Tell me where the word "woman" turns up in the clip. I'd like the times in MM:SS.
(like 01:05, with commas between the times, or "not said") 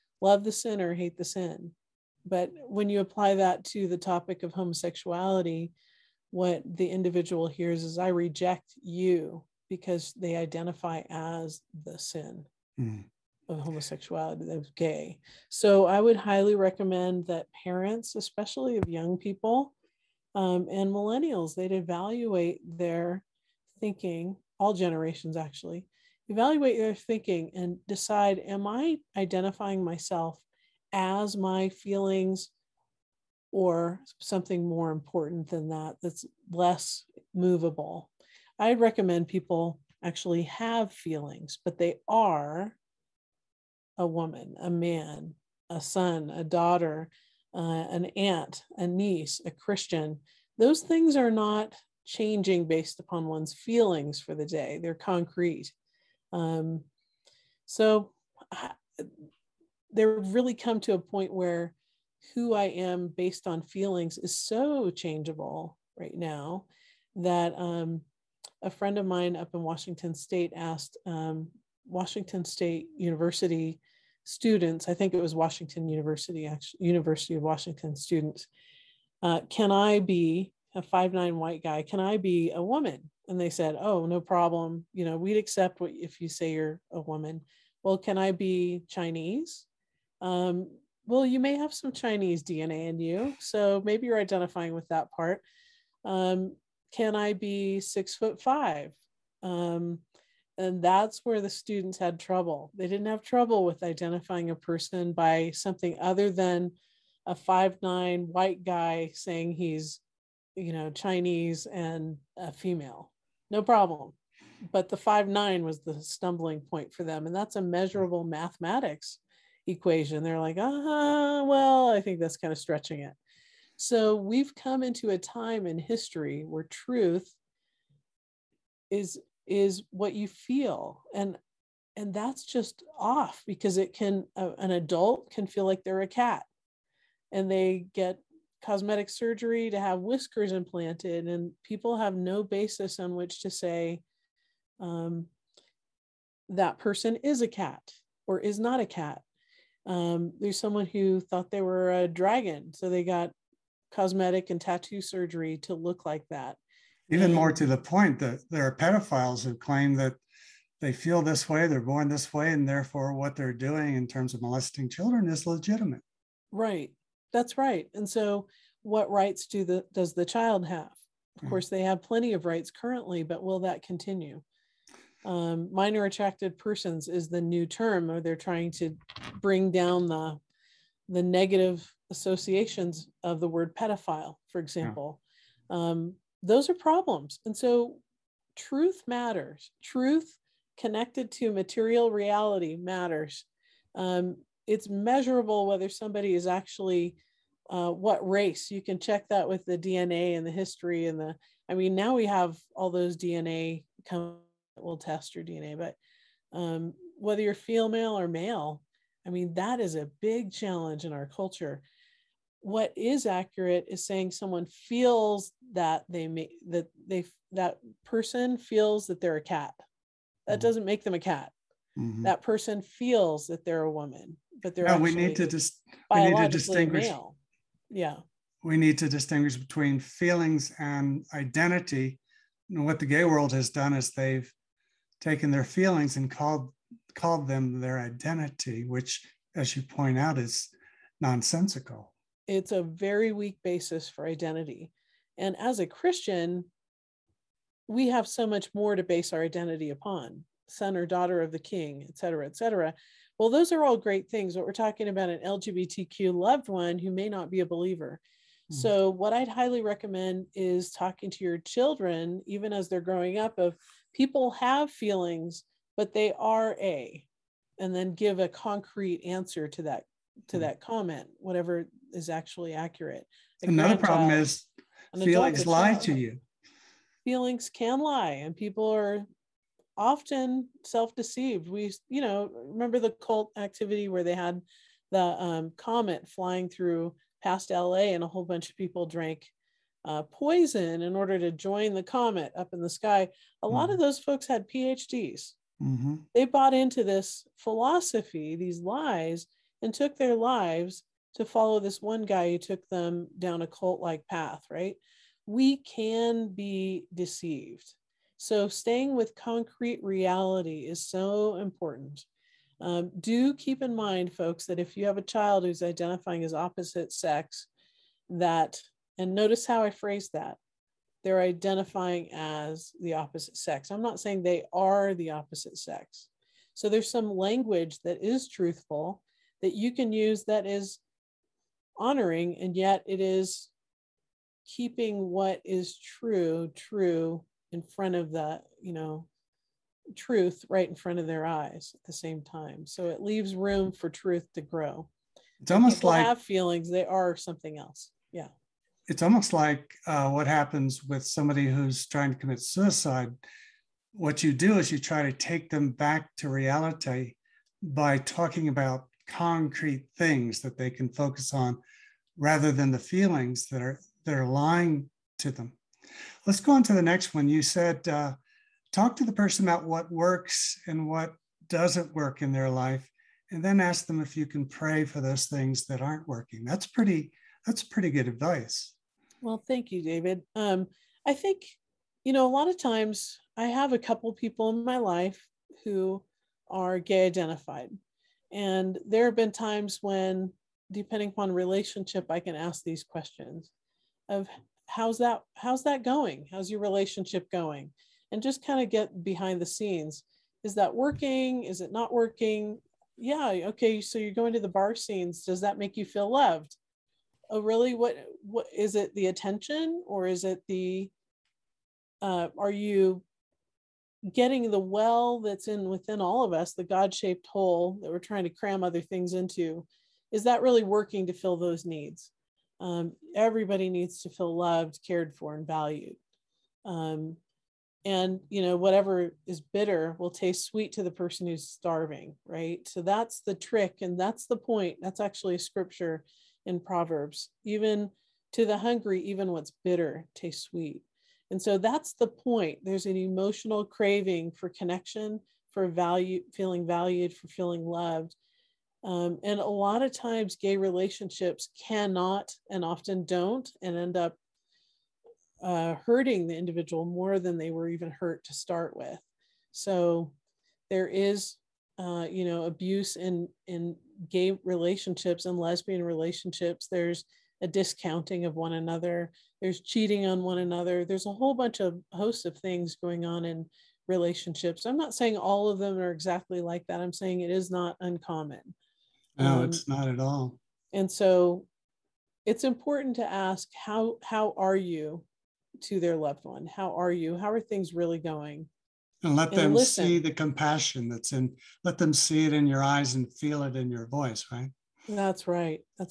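00:44, 01:22, 01:26, 03:43.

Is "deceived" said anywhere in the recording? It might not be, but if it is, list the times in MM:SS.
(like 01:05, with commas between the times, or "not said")
04:40, 05:07.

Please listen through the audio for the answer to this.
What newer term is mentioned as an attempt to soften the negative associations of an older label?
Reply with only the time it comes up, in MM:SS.
02:55.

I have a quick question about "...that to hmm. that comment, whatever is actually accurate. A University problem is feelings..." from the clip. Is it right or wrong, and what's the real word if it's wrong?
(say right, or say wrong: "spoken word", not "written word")
wrong: "Another", not "University".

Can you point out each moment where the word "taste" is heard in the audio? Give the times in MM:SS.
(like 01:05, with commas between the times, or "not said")
07:10, 07:20.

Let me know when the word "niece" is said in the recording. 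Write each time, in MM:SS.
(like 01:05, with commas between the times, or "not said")
00:48.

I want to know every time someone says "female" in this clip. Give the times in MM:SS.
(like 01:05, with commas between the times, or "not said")
01:52, 03:27.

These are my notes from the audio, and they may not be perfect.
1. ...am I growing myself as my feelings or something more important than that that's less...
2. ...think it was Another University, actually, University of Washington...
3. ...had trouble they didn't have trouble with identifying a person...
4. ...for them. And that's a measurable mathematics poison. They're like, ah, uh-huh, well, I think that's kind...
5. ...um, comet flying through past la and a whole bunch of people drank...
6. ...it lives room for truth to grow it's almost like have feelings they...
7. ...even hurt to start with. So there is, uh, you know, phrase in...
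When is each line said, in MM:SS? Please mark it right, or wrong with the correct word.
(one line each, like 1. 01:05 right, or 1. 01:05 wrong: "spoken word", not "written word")
1. 00:28 wrong: "identifying", not "growing"
2. 01:14 wrong: "Washington", not "Another"
3. 01:41 right
4. 01:56 wrong: "equation", not "poison"
5. 04:45 right
6. 05:43 wrong: "leaves", not "lives"
7. 07:37 wrong: "abuse", not "phrase".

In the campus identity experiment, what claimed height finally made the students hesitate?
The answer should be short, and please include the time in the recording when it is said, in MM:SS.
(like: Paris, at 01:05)
6 foot 5, at 01:37.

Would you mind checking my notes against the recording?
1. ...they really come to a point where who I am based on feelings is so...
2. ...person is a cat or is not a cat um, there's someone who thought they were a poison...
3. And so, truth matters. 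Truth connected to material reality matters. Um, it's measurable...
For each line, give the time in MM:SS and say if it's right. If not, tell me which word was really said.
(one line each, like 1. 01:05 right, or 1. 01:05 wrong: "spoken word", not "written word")
1. 00:59 right
2. 02:26 wrong: "dragon", not "poison"
3. 03:07 right.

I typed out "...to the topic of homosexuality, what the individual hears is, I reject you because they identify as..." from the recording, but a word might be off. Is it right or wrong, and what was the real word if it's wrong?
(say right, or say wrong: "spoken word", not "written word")
right.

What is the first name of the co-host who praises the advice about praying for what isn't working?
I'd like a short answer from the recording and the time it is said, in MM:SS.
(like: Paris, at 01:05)
David, at 06:20.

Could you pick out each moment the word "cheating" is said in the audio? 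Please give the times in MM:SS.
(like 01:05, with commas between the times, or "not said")
07:49.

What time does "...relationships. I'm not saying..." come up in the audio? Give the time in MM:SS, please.
07:54.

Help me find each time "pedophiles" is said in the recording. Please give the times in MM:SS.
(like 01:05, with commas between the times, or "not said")
02:38, 03:03.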